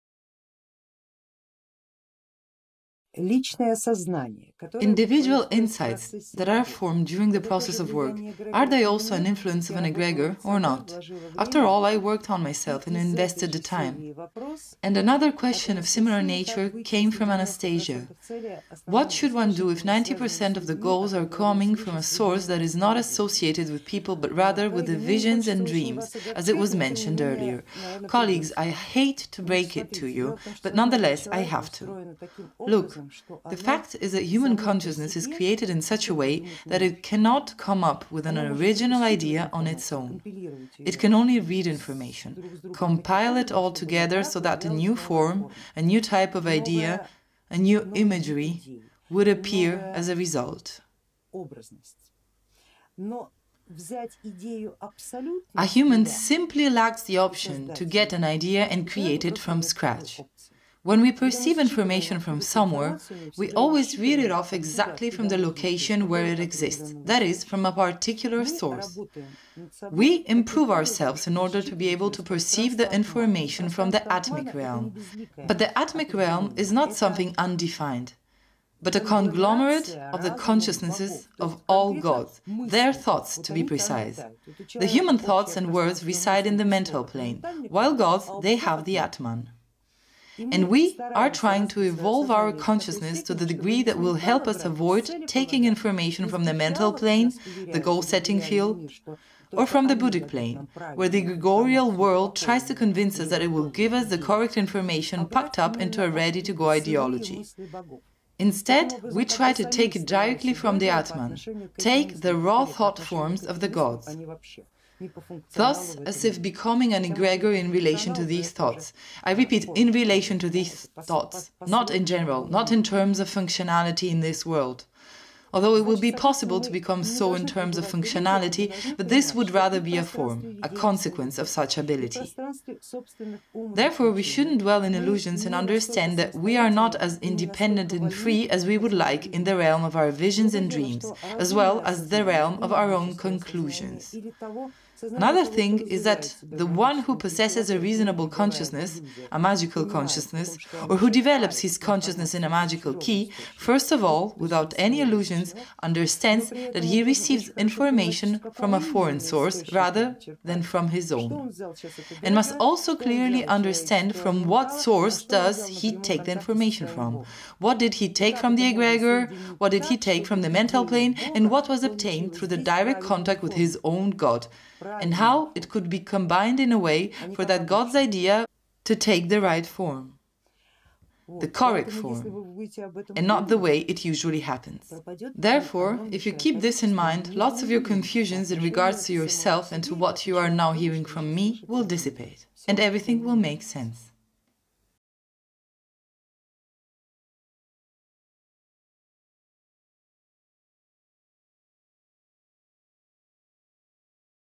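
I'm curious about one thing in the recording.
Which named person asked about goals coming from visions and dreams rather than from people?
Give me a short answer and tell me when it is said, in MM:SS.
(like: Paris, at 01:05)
Anastasia, at 00:17.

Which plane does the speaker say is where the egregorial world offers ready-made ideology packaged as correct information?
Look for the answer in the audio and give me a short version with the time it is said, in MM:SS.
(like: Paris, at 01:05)
Buddhic plane, at 01:39.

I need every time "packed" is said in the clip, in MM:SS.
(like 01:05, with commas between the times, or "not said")
01:45.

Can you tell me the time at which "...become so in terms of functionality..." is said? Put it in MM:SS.
02:06.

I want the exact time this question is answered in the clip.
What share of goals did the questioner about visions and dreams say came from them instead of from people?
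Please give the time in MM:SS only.
00:19.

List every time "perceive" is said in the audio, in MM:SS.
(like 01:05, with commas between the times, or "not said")
01:01, 01:12.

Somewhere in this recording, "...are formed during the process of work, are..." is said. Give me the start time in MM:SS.
00:06.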